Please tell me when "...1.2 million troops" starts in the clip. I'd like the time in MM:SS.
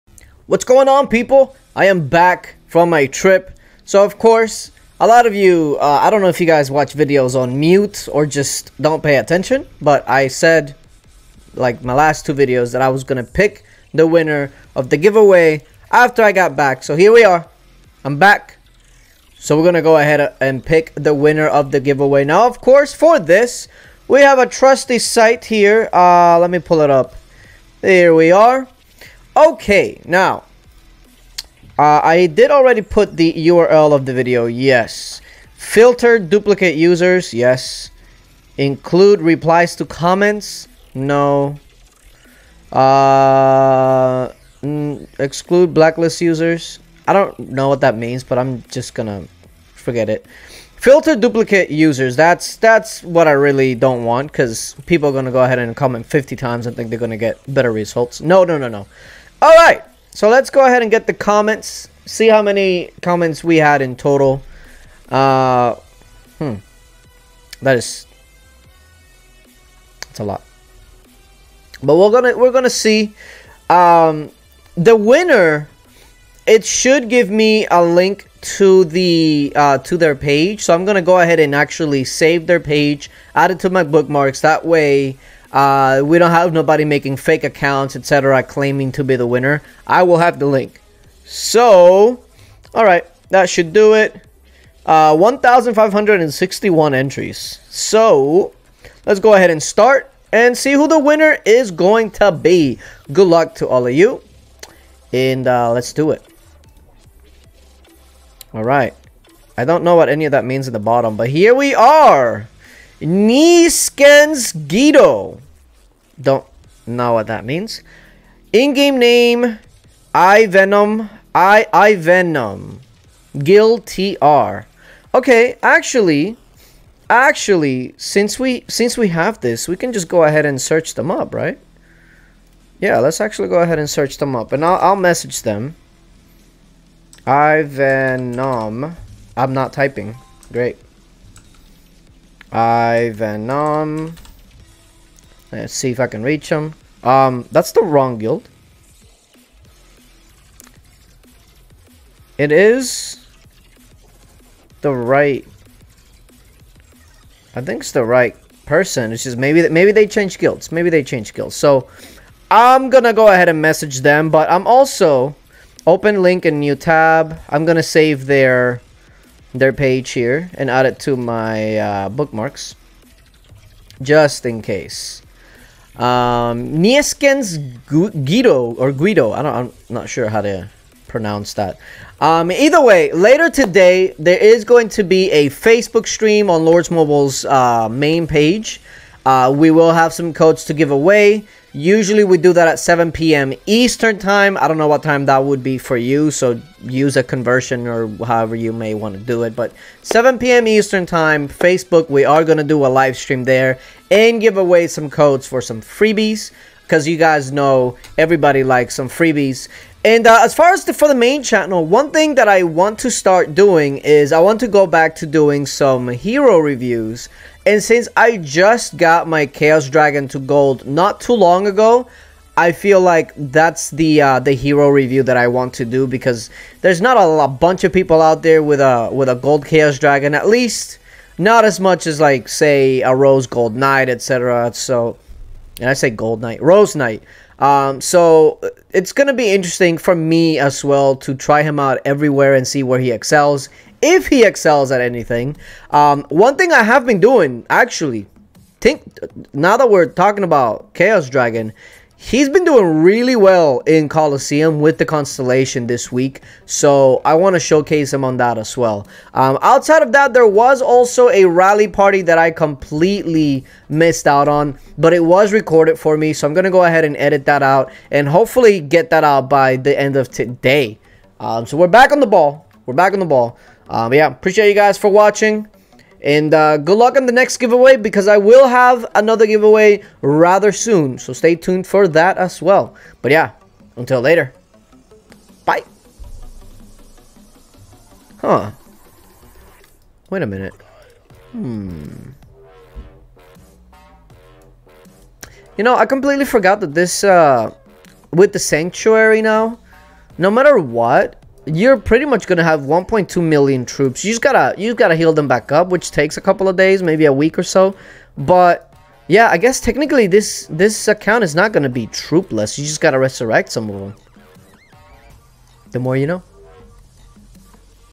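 05:02.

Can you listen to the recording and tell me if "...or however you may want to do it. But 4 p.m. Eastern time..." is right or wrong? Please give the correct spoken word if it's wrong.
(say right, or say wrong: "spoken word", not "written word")
wrong: "7", not "4".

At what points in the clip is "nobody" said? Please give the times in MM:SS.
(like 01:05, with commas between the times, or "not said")
01:26.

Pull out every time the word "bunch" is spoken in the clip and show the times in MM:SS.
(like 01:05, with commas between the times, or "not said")
03:47.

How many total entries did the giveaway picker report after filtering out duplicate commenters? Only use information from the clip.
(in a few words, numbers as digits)
1,561.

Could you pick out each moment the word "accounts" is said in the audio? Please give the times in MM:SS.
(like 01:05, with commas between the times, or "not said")
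01:27, 05:11.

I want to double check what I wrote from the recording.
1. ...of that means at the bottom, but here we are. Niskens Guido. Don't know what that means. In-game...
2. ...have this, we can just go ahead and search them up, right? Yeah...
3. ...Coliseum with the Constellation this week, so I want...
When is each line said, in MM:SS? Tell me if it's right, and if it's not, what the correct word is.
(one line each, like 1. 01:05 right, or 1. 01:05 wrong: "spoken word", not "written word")
1. 01:50 right
2. 02:09 right
3. 04:14 right.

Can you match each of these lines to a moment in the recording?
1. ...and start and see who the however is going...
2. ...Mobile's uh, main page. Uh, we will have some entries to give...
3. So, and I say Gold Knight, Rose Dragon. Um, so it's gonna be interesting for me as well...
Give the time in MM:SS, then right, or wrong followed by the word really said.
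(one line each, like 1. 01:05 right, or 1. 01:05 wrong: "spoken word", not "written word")
1. 01:39 wrong: "winner", not "however"
2. 03:06 wrong: "codes", not "entries"
3. 03:54 wrong: "Knight", not "Dragon".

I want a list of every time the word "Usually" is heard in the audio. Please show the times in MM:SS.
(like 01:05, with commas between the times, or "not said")
03:11.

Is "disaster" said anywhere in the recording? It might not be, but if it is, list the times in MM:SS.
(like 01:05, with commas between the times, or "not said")
not said.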